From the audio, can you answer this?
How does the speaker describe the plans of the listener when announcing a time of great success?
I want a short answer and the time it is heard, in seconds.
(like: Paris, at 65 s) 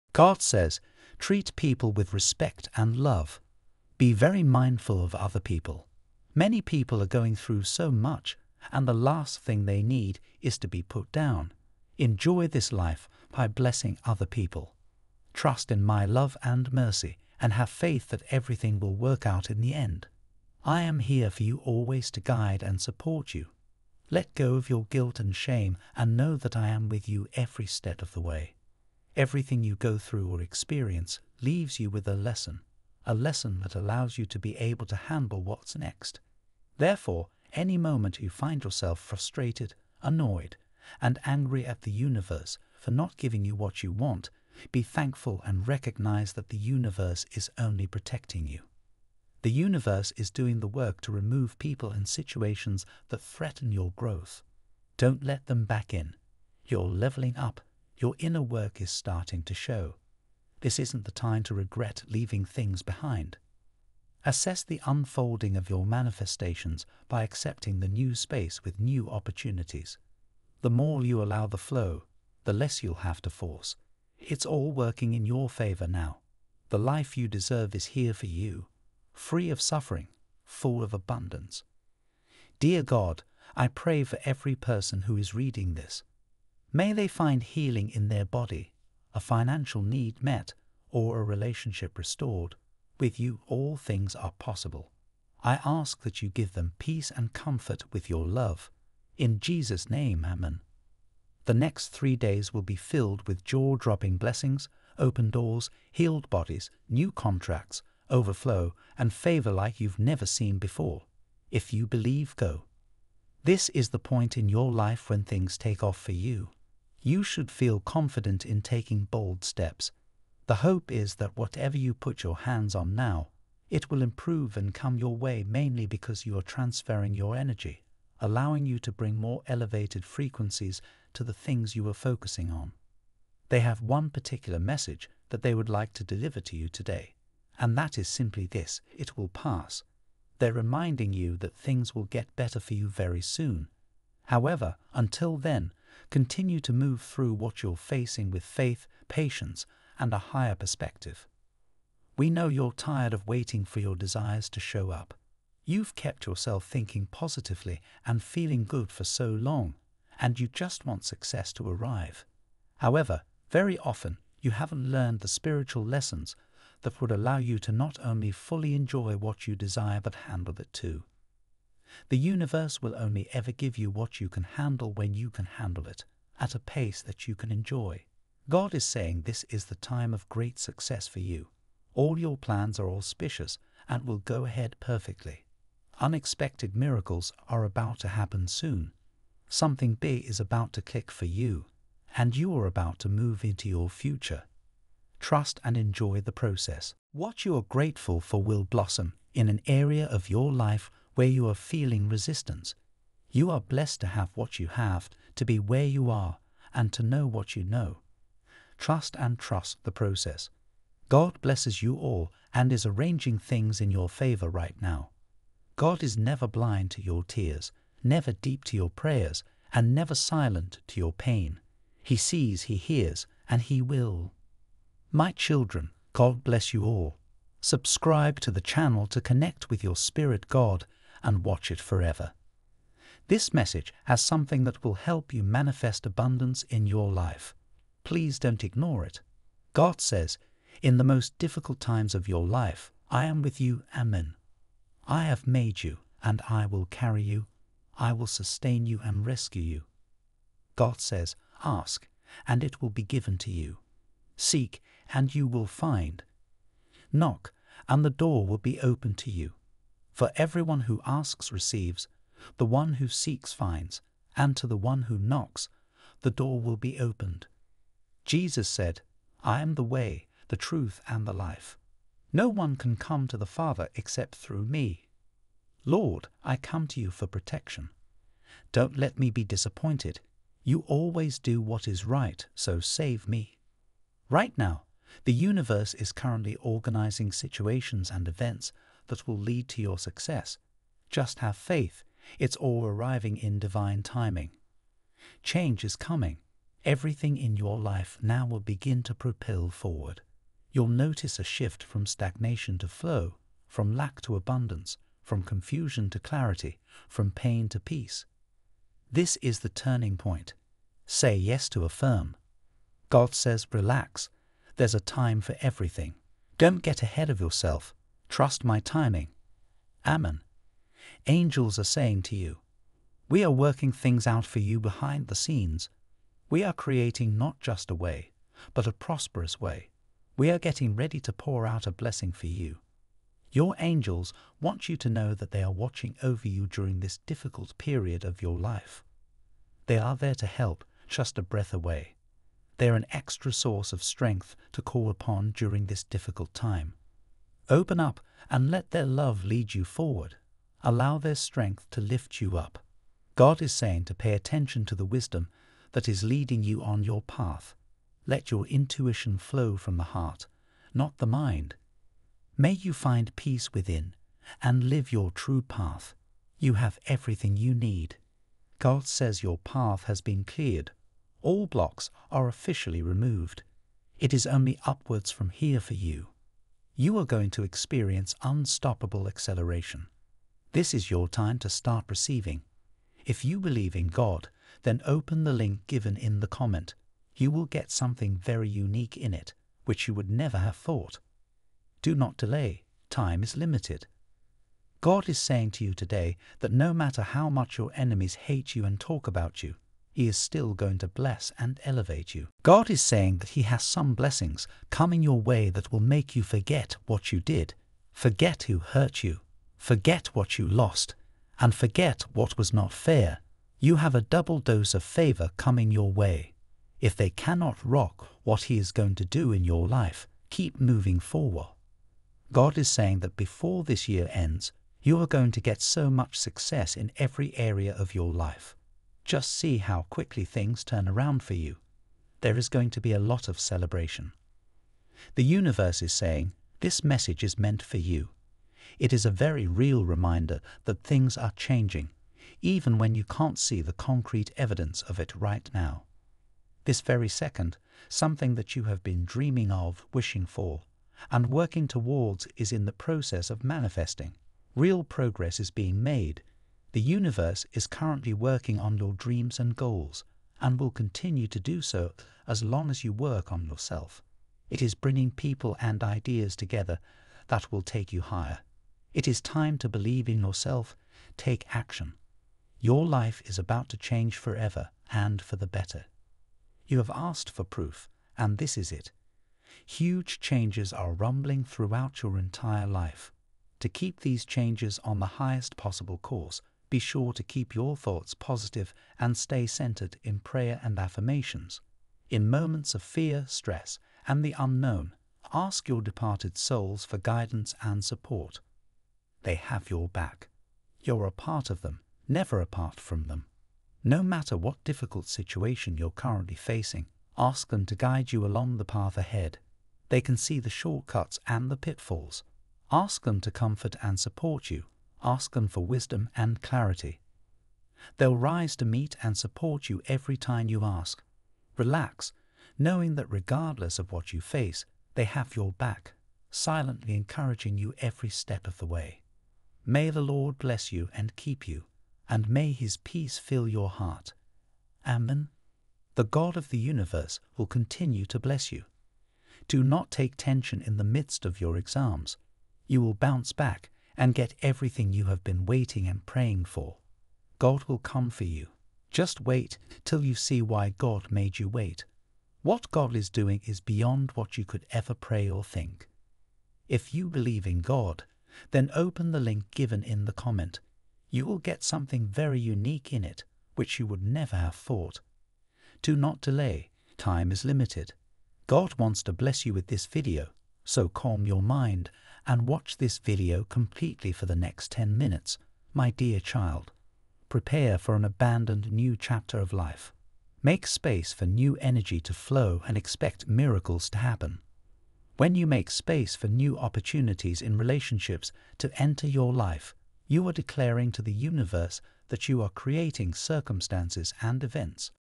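Auspicious, at 182 s.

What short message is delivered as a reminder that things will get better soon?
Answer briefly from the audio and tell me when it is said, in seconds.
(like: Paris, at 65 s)
It will pass, at 138 s.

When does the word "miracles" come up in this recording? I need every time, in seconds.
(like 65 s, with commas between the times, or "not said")
186 s, 583 s.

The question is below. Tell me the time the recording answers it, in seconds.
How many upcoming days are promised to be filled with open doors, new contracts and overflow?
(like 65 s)
101 s.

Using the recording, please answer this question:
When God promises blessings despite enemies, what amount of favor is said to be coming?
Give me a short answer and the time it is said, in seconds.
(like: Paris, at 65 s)
A double dose, at 414 s.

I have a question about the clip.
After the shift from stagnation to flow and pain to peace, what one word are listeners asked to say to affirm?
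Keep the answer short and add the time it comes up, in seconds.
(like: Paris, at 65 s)
Yes, at 311 s.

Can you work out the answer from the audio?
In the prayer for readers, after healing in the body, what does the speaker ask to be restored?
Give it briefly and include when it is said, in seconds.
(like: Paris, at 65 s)
A relationship, at 91 s.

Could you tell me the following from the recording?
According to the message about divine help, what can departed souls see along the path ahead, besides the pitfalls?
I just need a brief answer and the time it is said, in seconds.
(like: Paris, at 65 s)
The shortcuts, at 510 s.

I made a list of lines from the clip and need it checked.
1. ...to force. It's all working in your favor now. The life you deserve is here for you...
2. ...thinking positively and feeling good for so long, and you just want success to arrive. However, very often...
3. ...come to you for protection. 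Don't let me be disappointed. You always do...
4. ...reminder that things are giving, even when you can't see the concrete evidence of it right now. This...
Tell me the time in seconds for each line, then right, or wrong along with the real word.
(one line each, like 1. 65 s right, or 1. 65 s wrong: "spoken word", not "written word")
1. 73 s right
2. 156 s right
3. 276 s right
4. 440 s wrong: "changing", not "giving".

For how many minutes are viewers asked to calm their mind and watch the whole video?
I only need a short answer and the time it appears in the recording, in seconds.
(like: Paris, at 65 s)
10, at 574 s.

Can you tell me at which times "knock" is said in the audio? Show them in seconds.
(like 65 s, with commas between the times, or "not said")
257 s, 265 s.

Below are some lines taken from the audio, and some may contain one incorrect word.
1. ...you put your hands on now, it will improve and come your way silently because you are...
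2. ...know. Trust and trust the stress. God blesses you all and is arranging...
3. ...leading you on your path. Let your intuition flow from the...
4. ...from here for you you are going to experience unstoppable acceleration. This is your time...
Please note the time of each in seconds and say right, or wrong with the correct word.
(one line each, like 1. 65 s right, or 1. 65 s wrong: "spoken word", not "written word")
1. 121 s wrong: "mainly", not "silently"
2. 207 s wrong: "process", not "stress"
3. 356 s right
4. 375 s right.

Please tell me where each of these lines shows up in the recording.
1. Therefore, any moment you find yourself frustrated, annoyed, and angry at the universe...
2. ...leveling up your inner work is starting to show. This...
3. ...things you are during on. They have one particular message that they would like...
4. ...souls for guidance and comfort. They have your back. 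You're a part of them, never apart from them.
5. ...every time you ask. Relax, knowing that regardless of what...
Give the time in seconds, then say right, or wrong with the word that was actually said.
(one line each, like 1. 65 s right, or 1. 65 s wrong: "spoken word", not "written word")
1. 36 s right
2. 56 s right
3. 131 s wrong: "focusing", not "during"
4. 496 s wrong: "support", not "comfort"
5. 520 s right.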